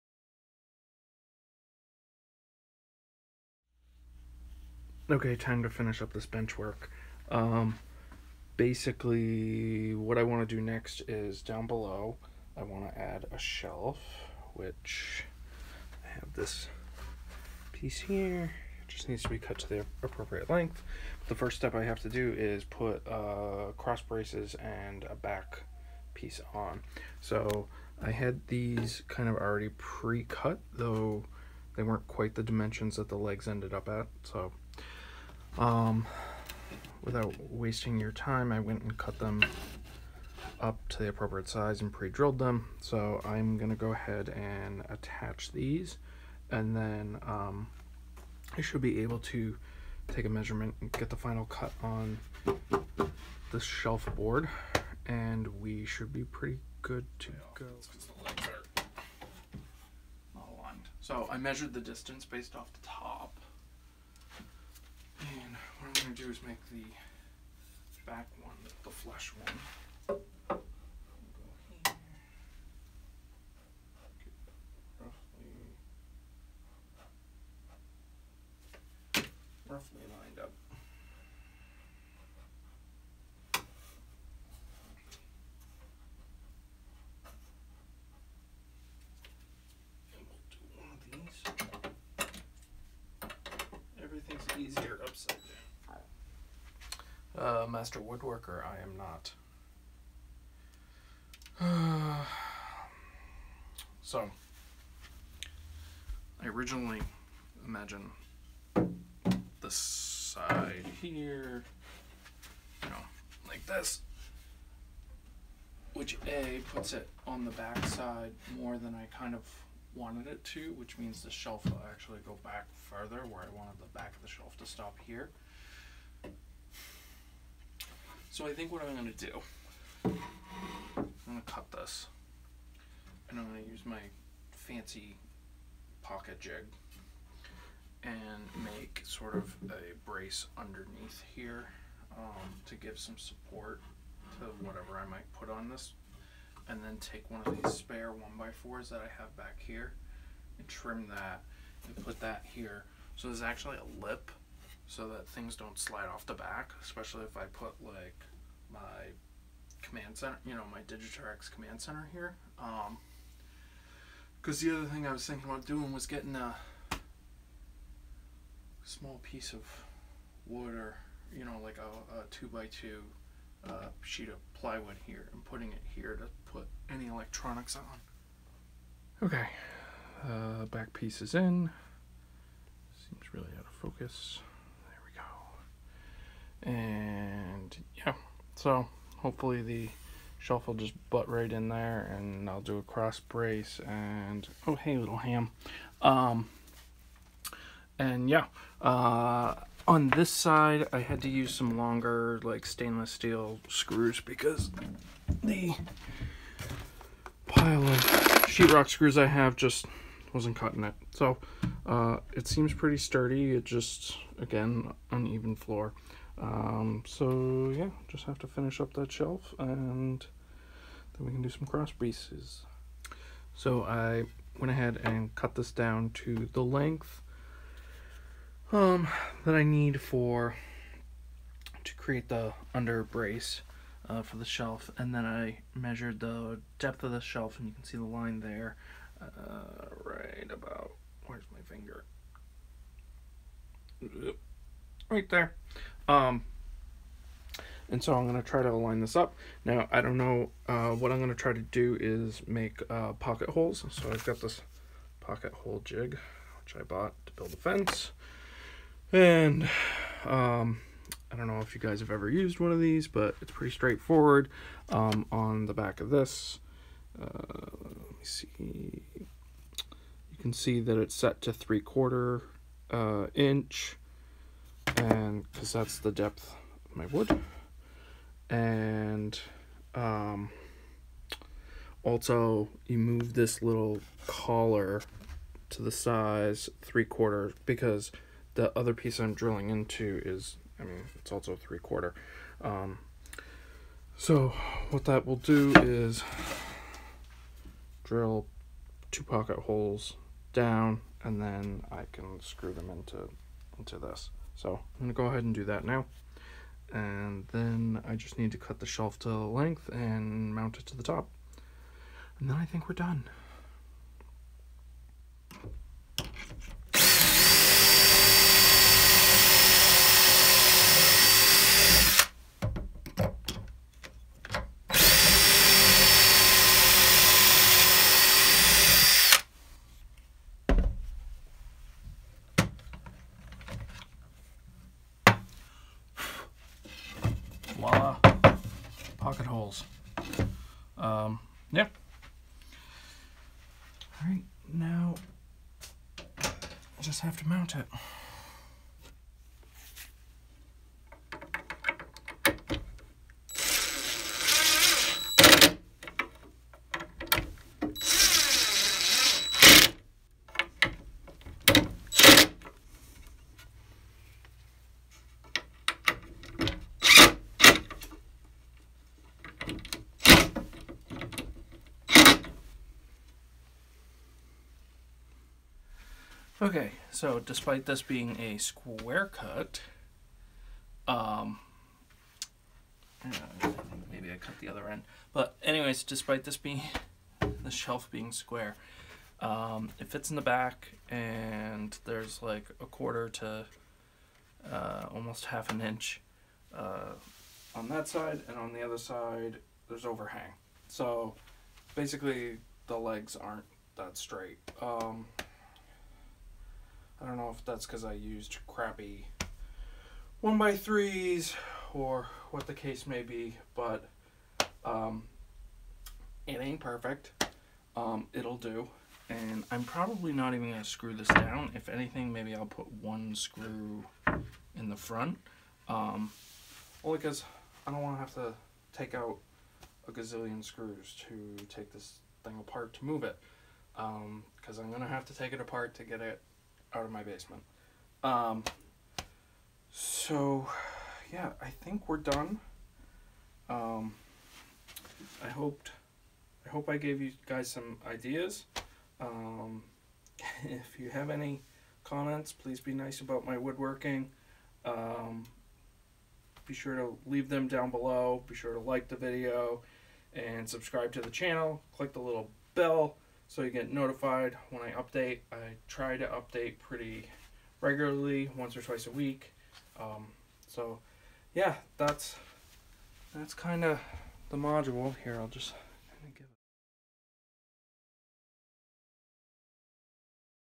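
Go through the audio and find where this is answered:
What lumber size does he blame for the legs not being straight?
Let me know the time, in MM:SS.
06:50.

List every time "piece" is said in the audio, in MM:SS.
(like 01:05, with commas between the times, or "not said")
00:17, 00:26, 02:49, 03:00, 03:41, 04:48.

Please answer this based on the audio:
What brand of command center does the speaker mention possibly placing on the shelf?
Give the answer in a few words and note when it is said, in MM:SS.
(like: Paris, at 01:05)
Digitrax, at 02:40.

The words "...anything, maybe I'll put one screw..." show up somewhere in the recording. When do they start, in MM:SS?
07:01.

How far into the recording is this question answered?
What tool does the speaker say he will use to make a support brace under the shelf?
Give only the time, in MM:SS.
02:16.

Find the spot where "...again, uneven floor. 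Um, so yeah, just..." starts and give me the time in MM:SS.
03:34.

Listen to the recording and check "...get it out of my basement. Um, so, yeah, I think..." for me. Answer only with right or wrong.
right.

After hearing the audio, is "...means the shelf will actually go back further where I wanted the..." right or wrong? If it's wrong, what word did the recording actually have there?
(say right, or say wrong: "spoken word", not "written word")
right.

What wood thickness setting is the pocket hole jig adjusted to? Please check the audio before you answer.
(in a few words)
3/4 inch.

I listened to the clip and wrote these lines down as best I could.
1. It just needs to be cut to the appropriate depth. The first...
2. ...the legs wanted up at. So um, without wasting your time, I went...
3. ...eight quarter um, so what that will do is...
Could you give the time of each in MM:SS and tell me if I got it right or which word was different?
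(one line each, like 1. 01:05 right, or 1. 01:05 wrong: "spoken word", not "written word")
1. 00:18 wrong: "length", not "depth"
2. 00:33 wrong: "ended", not "wanted"
3. 04:51 wrong: "three", not "eight".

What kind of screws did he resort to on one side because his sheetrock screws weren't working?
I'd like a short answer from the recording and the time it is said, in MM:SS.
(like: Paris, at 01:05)
stainless steel, at 03:22.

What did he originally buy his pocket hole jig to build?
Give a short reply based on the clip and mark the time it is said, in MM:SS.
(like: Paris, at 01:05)
a fence, at 04:17.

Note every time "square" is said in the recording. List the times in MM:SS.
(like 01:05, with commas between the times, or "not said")
06:18, 06:28.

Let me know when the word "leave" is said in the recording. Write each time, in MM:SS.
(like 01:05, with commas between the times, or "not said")
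07:37.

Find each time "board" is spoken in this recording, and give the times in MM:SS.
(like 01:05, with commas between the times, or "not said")
00:54.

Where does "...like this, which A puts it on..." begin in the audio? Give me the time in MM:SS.
01:53.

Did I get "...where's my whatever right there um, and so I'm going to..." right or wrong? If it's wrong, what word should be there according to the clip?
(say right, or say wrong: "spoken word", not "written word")
wrong: "finger", not "whatever".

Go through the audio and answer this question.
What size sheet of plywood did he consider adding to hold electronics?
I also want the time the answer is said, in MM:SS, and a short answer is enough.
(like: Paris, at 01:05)
2 by 2, at 02:52.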